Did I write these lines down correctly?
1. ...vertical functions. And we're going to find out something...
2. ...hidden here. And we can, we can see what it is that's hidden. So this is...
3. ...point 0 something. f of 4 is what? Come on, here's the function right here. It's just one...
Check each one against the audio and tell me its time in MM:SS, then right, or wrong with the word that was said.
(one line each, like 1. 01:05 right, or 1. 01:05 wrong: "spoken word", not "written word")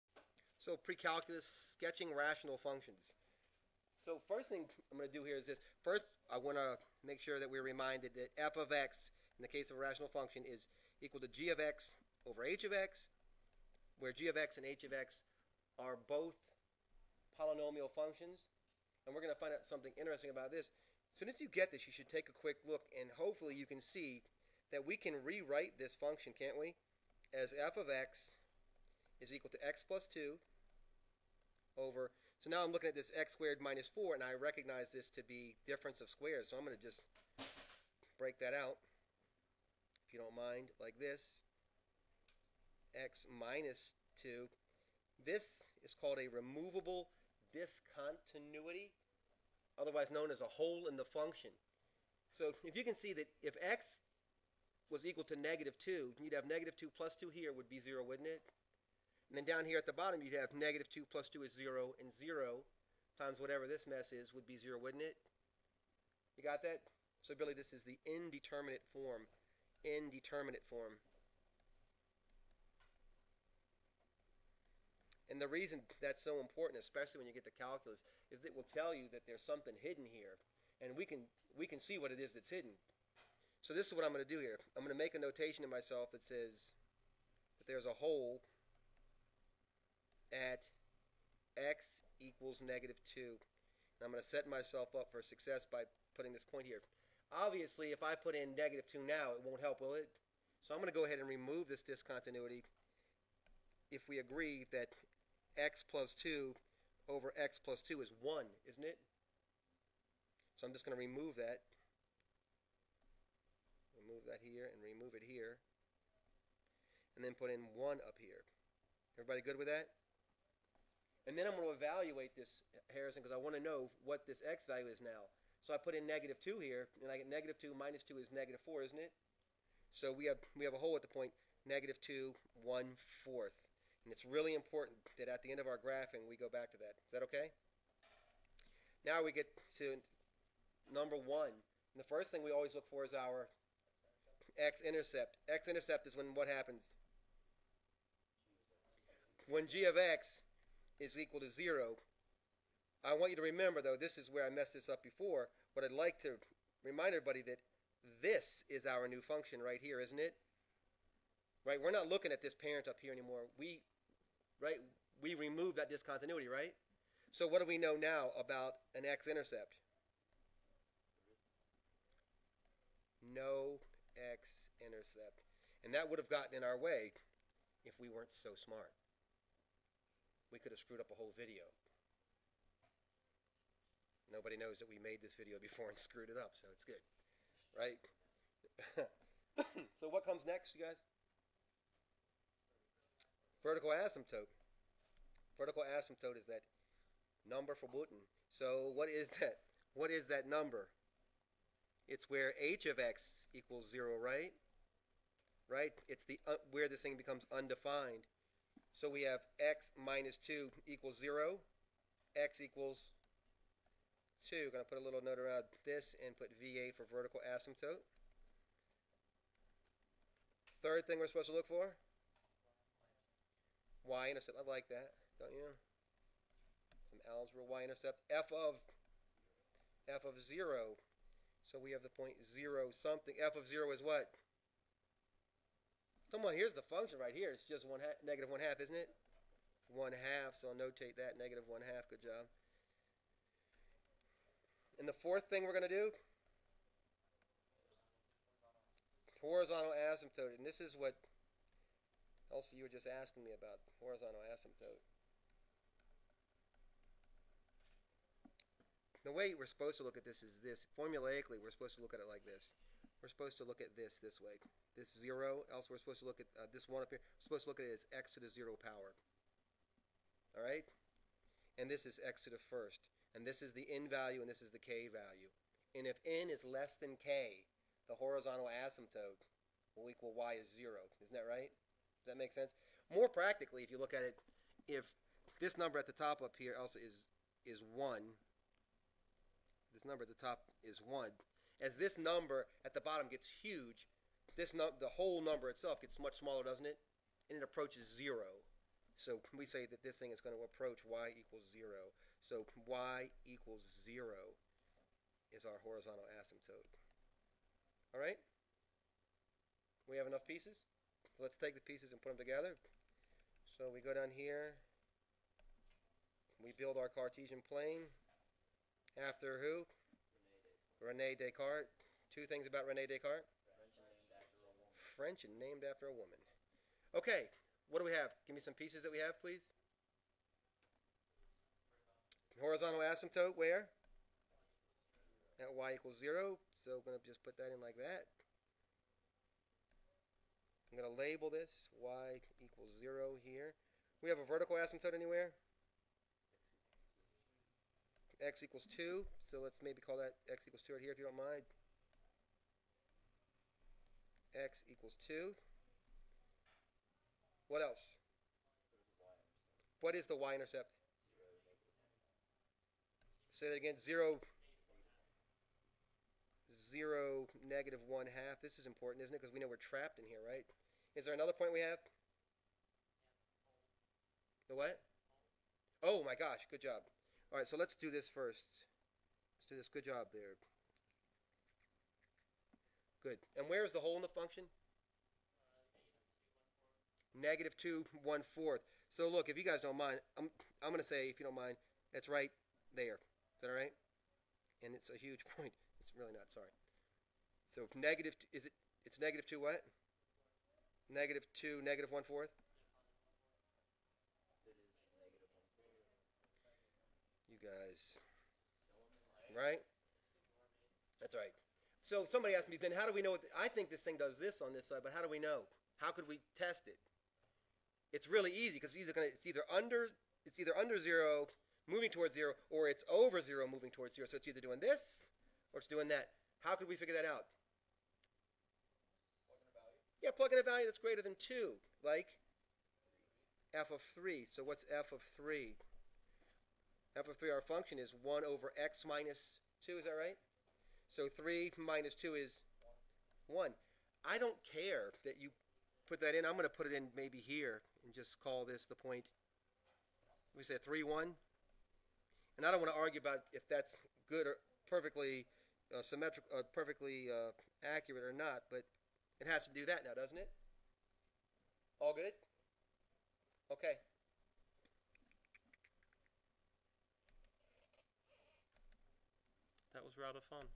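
1. 00:17 wrong: "polynomial", not "vertical"
2. 01:19 right
3. 03:52 wrong: "0", not "4".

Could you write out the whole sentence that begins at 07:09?
Plug yeah, plug in a value that's greater than two, like f of three.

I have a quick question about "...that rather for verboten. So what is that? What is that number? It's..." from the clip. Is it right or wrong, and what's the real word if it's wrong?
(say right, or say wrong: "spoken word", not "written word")
wrong: "number", not "rather".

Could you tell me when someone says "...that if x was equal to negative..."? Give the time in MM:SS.
00:53.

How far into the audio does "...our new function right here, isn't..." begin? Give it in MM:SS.
02:38.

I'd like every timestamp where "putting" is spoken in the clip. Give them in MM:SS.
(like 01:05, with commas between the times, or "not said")
01:36.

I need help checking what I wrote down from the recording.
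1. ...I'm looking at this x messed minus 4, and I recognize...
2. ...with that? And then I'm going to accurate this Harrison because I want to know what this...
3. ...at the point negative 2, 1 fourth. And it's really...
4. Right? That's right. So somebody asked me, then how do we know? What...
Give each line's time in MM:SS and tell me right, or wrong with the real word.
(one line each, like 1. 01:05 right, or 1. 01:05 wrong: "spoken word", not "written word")
1. 00:32 wrong: "squared", not "messed"
2. 01:59 wrong: "evaluate", not "accurate"
3. 02:10 right
4. 06:49 right.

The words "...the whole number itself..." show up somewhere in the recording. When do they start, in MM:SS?
04:55.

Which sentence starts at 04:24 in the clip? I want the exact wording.
This 0, else we're supposed to look at uh, this 1 up here.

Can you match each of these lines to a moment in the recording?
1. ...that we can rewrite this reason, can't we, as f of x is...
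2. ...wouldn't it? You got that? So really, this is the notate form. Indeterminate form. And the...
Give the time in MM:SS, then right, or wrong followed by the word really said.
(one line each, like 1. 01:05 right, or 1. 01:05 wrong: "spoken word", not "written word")
1. 00:24 wrong: "function", not "reason"
2. 01:04 wrong: "indeterminate", not "notate".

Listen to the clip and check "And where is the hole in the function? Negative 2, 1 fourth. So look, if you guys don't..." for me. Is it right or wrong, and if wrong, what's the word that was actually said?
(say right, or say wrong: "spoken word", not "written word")
right.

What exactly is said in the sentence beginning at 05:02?
So y equals zero is our horizontal asymptote.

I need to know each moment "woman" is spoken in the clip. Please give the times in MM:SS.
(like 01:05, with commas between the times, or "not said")
05:26.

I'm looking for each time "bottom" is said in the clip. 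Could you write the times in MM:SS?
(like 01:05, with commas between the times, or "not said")
00:59, 04:53.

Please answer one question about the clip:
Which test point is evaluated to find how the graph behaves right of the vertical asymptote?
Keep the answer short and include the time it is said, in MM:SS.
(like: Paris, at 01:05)
(3, 1), at 07:30.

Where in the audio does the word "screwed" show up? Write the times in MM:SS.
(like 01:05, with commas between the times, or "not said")
03:00, 03:05.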